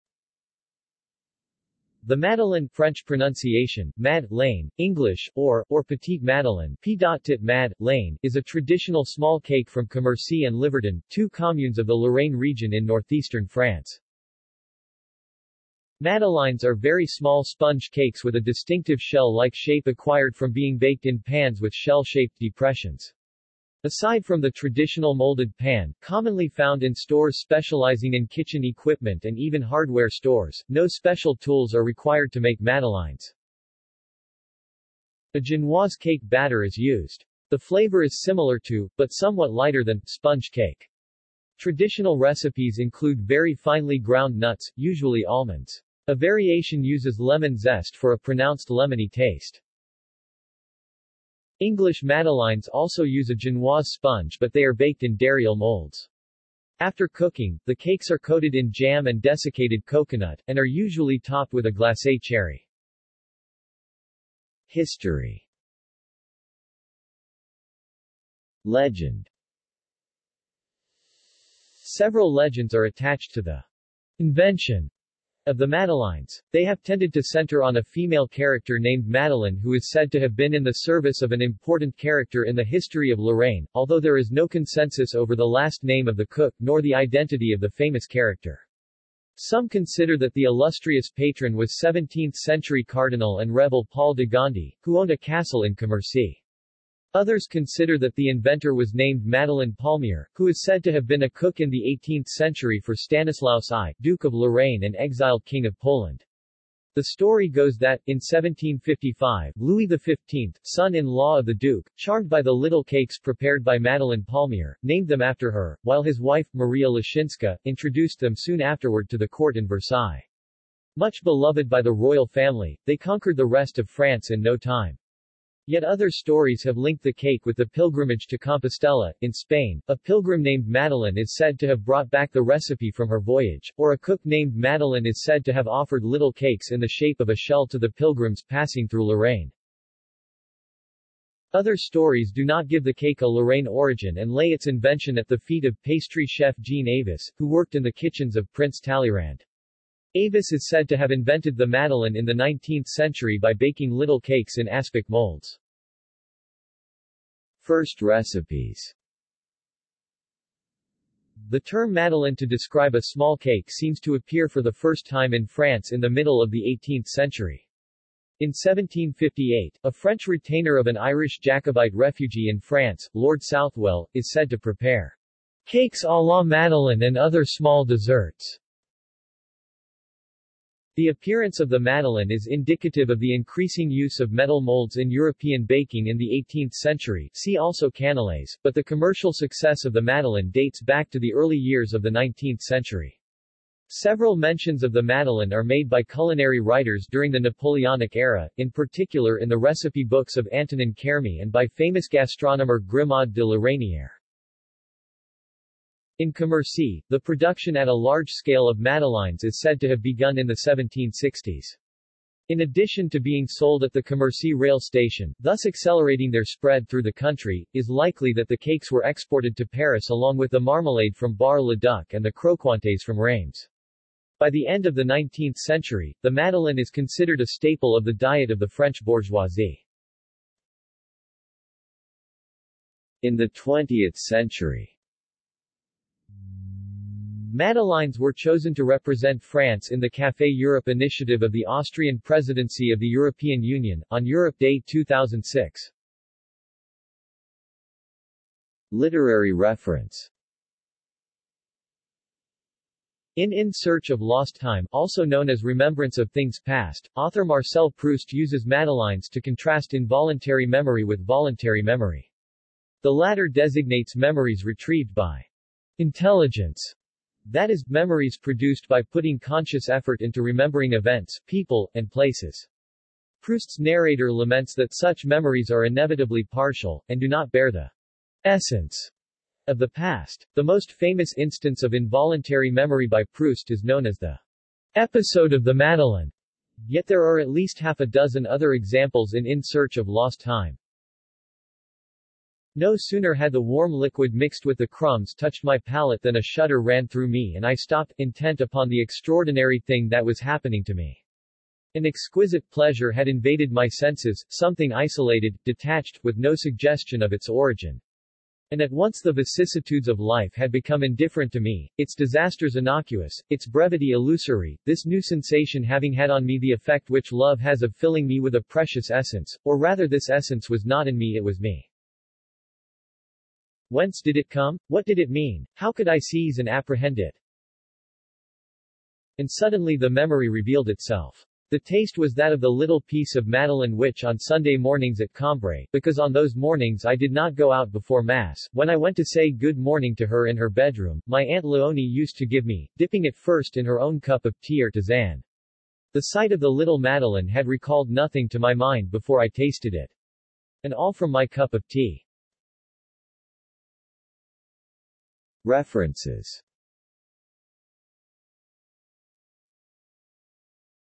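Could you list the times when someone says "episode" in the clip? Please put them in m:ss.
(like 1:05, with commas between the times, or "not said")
4:44.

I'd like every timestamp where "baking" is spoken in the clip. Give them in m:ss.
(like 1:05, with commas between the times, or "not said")
2:33, 3:05.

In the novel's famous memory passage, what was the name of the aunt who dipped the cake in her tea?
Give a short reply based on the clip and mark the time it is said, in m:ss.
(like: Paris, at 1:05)
Aunt Leonie, at 5:41.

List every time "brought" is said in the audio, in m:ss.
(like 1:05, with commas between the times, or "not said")
2:11.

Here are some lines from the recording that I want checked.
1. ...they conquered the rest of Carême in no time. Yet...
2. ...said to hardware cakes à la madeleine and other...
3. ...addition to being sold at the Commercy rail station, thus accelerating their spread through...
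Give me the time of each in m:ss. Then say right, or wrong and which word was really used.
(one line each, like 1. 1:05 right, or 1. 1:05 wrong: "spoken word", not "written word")
1. 2:02 wrong: "France", not "Carême"
2. 2:54 wrong: "prepare", not "hardware"
3. 3:32 right.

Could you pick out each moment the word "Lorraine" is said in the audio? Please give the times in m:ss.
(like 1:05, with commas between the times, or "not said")
0:11, 1:23, 1:44, 2:19, 2:23.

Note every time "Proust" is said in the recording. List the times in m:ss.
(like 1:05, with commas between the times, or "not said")
4:17, 4:33, 4:43.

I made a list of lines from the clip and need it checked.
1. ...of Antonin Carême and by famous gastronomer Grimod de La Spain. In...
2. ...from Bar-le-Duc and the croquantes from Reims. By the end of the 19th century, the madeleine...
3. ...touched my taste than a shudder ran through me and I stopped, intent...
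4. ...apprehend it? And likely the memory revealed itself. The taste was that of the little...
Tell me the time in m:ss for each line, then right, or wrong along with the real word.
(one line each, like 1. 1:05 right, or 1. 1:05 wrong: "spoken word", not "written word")
1. 3:20 wrong: "Reynière", not "Spain"
2. 3:41 right
3. 4:55 wrong: "palate", not "taste"
4. 5:26 wrong: "suddenly", not "likely".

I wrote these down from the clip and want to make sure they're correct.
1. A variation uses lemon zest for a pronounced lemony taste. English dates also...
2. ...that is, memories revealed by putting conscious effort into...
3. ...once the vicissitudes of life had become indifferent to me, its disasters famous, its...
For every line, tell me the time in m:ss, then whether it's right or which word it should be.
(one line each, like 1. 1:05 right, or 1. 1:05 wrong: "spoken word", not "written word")
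1. 0:46 wrong: "madeleines", not "dates"
2. 4:27 wrong: "produced", not "revealed"
3. 5:08 wrong: "innocuous", not "famous".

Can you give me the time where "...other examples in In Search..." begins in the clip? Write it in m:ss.
4:48.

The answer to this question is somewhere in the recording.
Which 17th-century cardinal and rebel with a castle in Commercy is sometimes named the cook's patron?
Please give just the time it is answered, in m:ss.
1:33.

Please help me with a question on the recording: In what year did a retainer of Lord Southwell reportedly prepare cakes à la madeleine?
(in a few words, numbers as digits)
1758.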